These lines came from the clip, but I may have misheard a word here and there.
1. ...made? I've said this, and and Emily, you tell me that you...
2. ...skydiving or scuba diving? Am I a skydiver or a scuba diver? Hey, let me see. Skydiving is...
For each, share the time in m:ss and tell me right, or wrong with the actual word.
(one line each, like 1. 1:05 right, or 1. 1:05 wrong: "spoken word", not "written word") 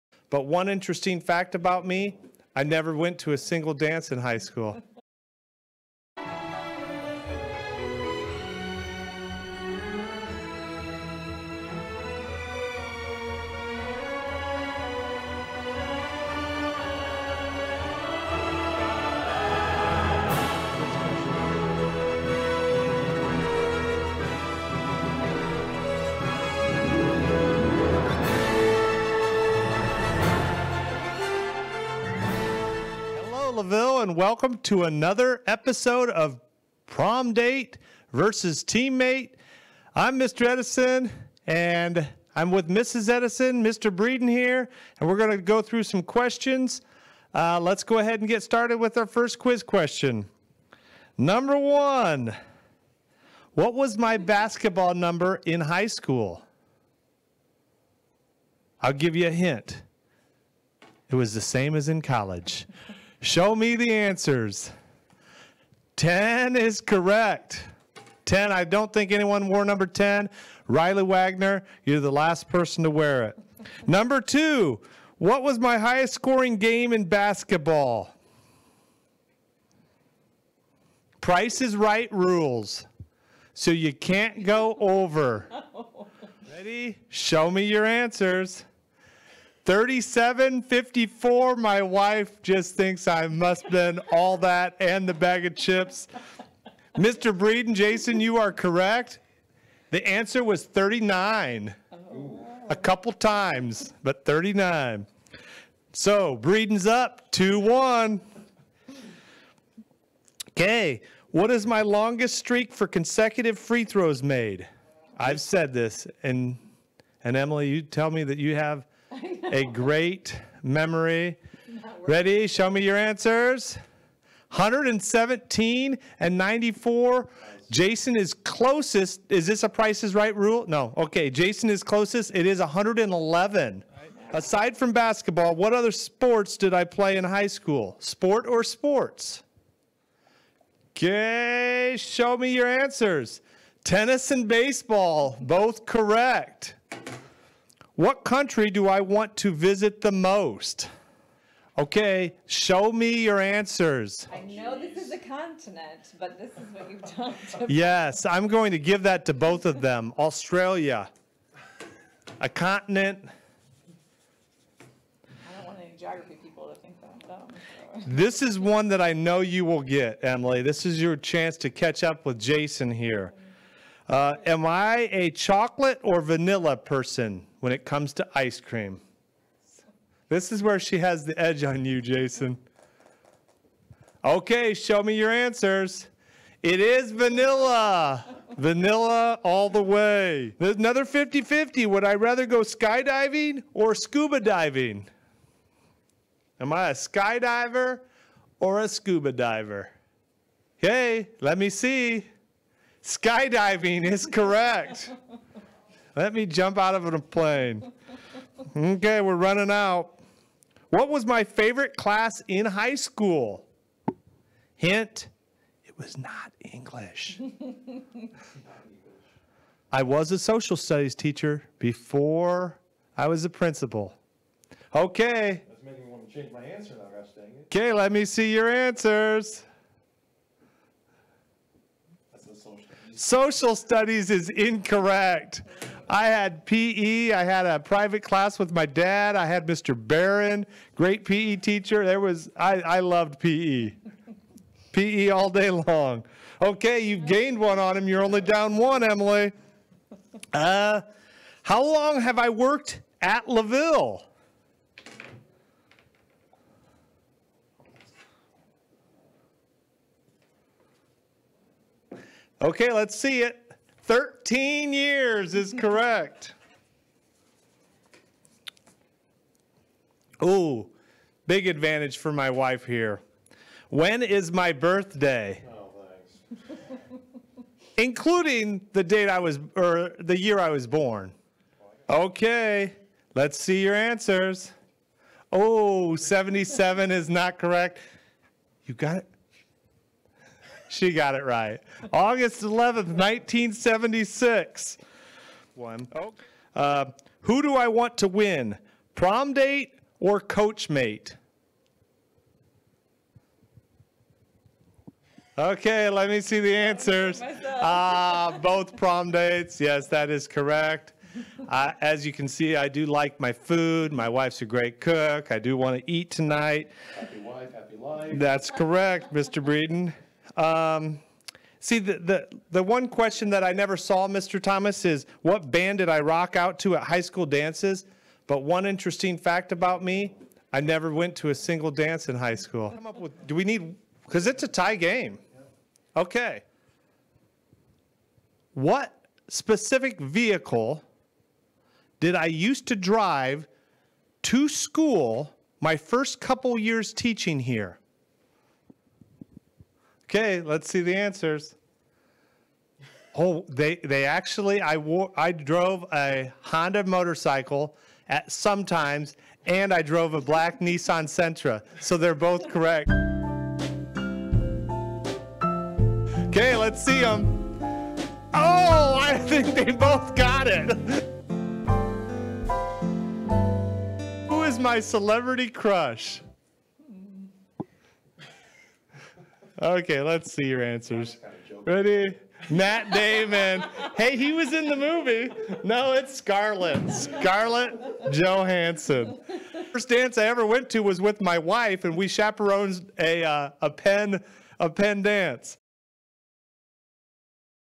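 1. 1:54 right
2. 3:12 right.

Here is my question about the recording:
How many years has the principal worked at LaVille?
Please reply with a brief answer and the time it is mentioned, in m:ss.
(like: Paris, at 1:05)
13 years, at 4:24.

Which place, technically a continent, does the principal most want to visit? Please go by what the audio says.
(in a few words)
Australia.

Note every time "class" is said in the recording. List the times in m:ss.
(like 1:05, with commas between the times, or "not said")
3:31, 3:58.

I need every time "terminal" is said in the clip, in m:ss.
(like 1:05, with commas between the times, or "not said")
not said.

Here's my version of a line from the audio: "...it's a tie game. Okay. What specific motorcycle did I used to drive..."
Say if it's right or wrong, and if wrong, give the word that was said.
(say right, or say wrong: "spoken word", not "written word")
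wrong: "vehicle", not "motorcycle".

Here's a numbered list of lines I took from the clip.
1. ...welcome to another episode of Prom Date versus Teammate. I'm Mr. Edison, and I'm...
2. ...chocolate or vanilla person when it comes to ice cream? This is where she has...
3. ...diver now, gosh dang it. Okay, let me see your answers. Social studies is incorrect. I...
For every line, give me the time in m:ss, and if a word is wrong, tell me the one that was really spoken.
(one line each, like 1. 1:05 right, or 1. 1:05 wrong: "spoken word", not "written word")
1. 0:34 right
2. 2:55 right
3. 3:46 wrong: "answer", not "diver".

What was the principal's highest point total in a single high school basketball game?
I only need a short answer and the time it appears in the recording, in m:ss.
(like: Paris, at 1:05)
39, at 1:39.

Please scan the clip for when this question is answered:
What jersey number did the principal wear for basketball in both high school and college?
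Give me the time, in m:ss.
1:05.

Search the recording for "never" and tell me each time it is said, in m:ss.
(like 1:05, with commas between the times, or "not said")
0:02, 5:23, 5:30.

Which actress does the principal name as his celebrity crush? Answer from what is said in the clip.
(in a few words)
Scarlett Johansson.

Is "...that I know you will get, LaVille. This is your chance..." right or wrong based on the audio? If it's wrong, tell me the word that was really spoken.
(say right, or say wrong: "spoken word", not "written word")
wrong: "Emily", not "LaVille".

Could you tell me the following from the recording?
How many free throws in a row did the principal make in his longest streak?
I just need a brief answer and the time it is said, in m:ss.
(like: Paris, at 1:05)
111, at 2:12.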